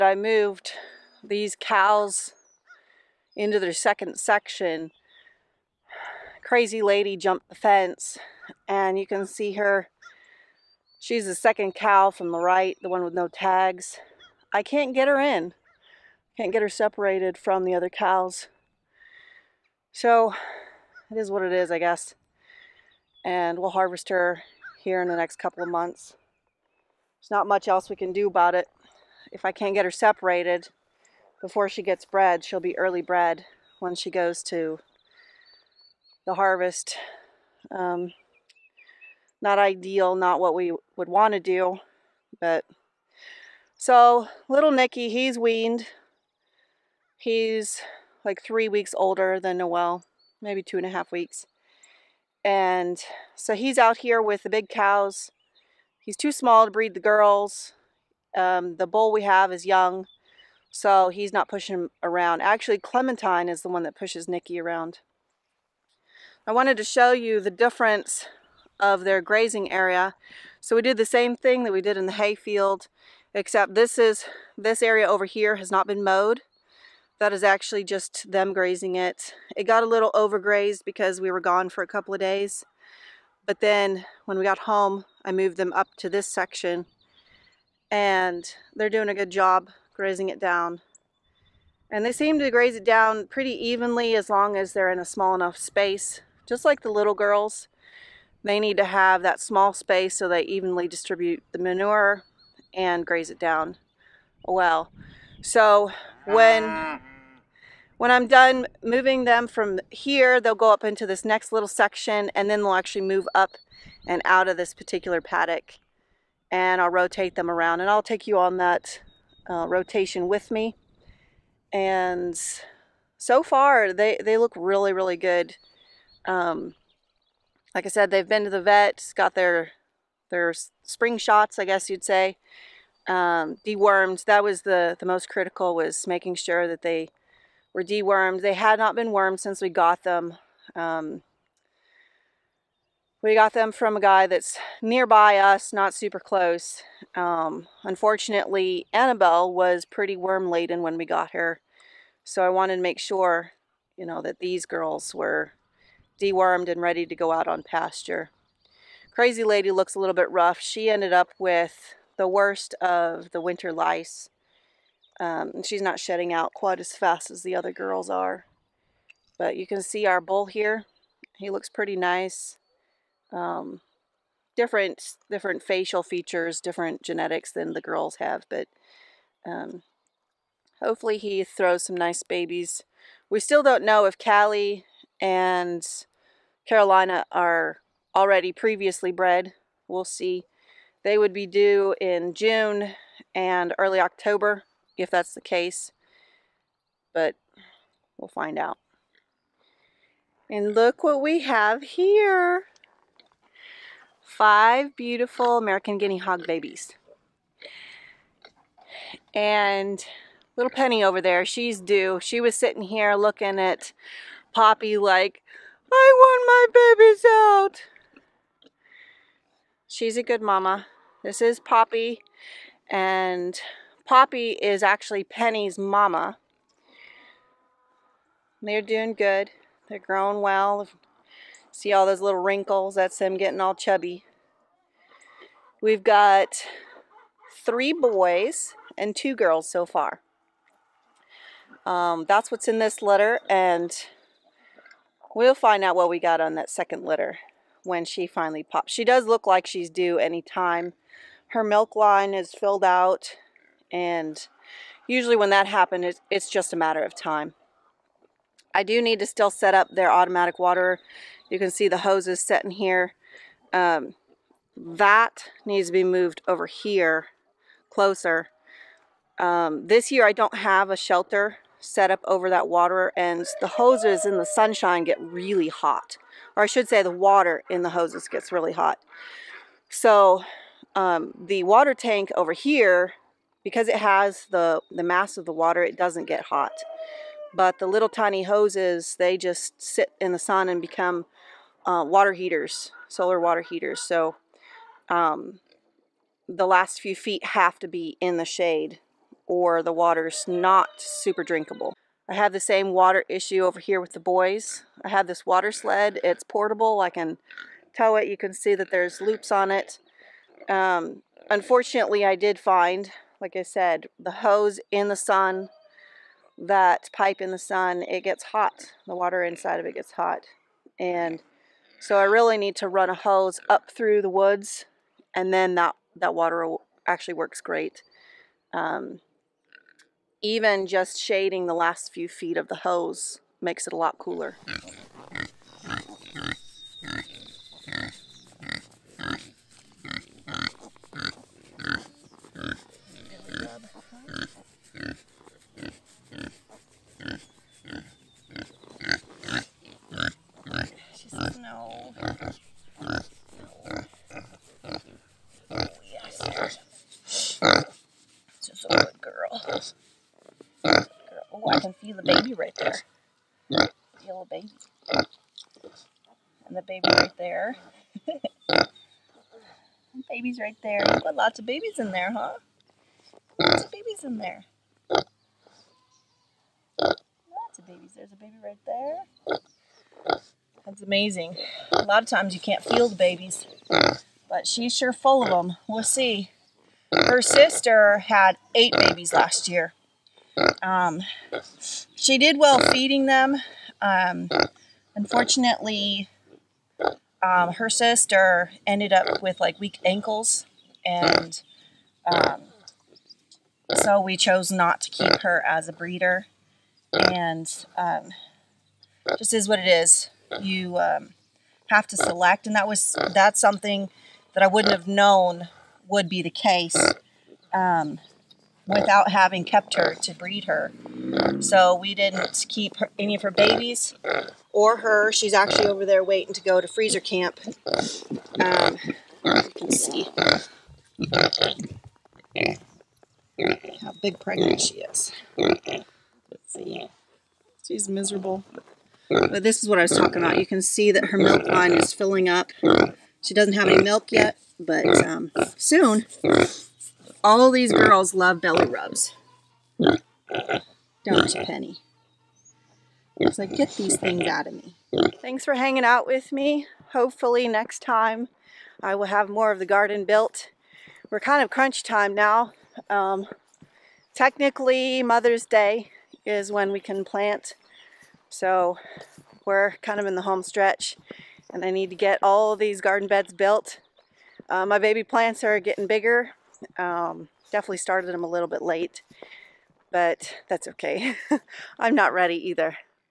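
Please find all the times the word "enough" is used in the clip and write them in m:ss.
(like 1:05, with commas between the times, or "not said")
1:35.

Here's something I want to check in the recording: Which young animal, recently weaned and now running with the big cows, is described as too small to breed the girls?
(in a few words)
Nicky.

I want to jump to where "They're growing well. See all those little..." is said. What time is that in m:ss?
3:49.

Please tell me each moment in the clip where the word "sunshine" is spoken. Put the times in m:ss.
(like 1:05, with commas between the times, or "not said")
4:34.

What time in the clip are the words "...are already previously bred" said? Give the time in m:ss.
3:07.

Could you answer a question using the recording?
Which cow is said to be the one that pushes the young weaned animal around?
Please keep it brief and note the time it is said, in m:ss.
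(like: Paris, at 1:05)
Clementine, at 1:02.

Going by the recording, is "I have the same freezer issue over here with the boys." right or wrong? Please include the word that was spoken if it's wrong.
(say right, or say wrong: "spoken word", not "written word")
wrong: "water", not "freezer".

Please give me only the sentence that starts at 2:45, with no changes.
Um, and she's not shedding out quite as fast as the other girls are.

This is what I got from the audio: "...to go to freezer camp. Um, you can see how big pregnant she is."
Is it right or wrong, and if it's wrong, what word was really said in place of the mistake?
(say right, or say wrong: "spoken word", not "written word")
right.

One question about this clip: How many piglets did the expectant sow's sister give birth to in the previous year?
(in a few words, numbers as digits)
8.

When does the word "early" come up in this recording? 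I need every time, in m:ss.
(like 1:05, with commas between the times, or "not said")
0:32, 3:13.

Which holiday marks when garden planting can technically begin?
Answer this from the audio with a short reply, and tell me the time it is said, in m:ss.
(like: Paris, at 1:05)
Mother's Day, at 7:45.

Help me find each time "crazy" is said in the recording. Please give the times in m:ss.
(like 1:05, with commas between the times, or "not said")
0:06, 2:39.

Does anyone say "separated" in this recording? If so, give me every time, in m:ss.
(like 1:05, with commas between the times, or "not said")
0:16, 0:29.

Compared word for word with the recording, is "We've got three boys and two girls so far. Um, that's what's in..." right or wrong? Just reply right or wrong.
right.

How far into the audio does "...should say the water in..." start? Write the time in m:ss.
4:36.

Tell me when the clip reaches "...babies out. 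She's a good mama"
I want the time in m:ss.
3:37.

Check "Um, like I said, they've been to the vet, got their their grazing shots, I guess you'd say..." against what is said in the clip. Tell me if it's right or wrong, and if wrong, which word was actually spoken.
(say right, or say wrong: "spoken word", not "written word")
wrong: "spring", not "grazing".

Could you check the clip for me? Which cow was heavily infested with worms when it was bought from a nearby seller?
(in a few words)
Annabelle.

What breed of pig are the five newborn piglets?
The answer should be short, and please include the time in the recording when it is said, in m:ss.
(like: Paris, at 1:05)
American guinea hog, at 3:25.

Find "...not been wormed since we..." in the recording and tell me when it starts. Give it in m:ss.
2:18.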